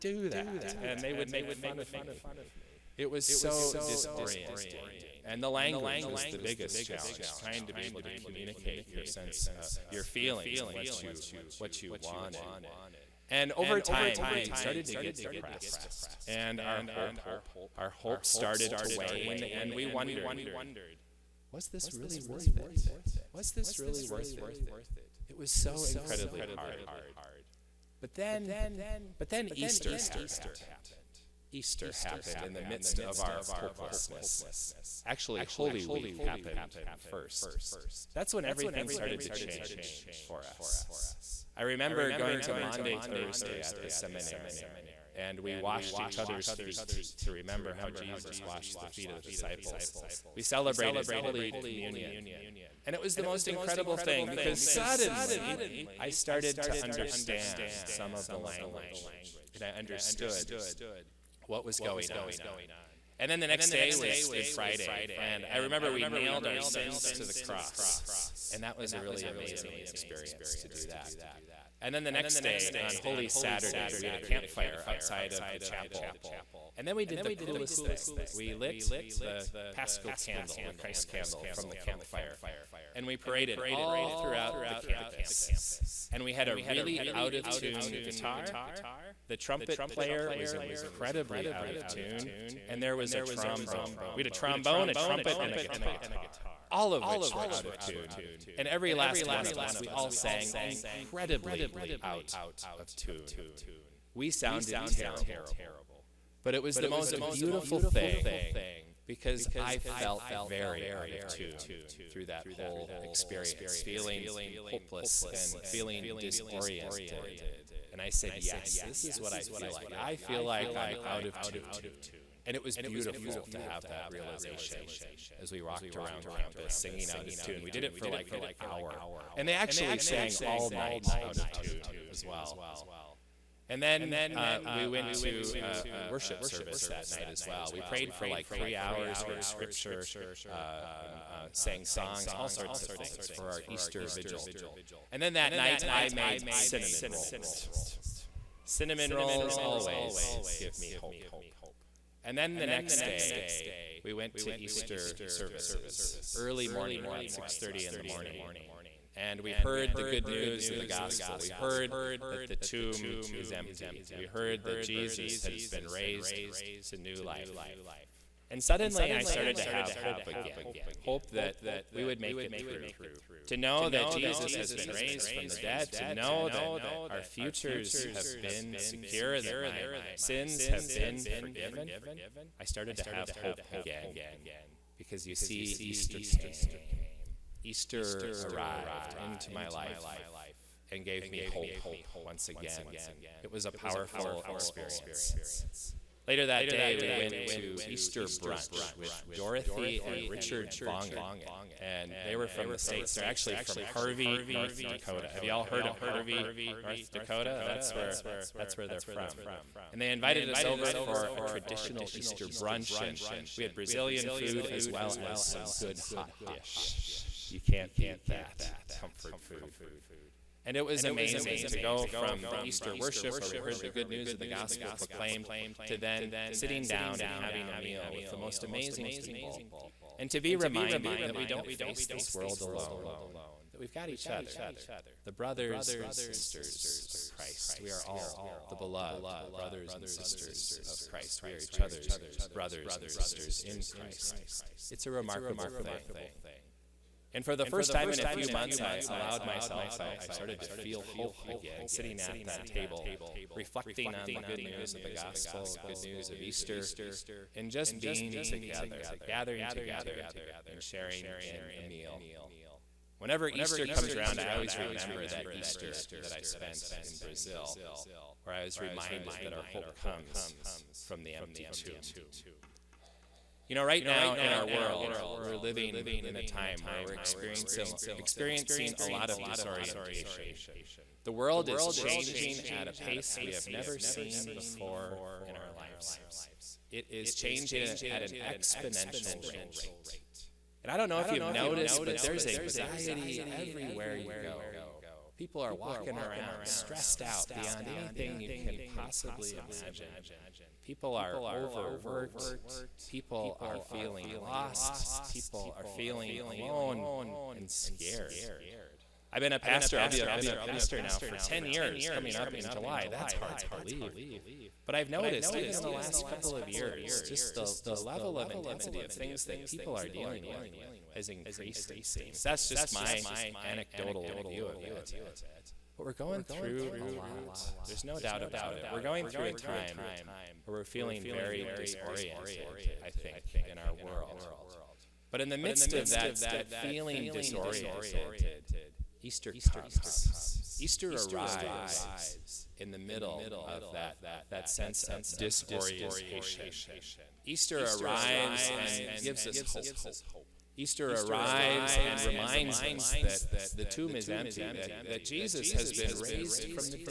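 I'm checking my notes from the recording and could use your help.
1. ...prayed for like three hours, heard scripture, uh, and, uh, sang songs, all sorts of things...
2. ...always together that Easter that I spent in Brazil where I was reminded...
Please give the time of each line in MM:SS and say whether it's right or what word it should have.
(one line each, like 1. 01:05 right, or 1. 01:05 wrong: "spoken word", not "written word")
1. 02:17 right
2. 04:24 wrong: "remember", not "together".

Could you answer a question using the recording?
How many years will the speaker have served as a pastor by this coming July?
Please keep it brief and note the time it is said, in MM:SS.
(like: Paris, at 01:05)
10, at 05:11.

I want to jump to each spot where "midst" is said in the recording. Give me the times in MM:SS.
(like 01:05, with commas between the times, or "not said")
00:32, 05:35.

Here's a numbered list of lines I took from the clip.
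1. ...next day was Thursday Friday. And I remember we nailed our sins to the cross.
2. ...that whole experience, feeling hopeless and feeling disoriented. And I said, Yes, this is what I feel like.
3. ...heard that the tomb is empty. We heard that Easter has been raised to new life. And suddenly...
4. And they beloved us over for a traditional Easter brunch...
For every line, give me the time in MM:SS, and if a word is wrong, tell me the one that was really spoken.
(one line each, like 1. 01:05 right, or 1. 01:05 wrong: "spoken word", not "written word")
1. 01:03 wrong: "Good", not "Thursday"
2. 01:52 right
3. 02:41 wrong: "Jesus", not "Easter"
4. 03:29 wrong: "invited", not "beloved".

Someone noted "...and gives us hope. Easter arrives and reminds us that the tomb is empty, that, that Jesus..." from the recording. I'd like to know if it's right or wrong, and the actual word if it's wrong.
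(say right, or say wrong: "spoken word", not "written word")
right.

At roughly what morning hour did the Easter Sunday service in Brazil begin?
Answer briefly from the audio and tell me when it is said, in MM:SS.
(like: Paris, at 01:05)
6:30, at 02:37.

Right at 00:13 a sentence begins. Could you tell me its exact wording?
And over time, we started to get depressed and our hope.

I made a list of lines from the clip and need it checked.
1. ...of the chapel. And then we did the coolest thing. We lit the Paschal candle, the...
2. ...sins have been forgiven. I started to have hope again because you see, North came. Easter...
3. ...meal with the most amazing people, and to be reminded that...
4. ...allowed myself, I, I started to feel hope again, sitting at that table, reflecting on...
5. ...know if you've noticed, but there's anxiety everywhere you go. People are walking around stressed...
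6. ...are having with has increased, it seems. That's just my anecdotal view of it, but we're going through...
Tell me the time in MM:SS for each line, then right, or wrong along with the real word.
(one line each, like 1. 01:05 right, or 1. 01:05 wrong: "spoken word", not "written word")
1. 01:15 right
2. 03:00 wrong: "Easter", not "North"
3. 03:47 right
4. 04:09 right
5. 04:51 right
6. 05:19 wrong: "dealing", not "having".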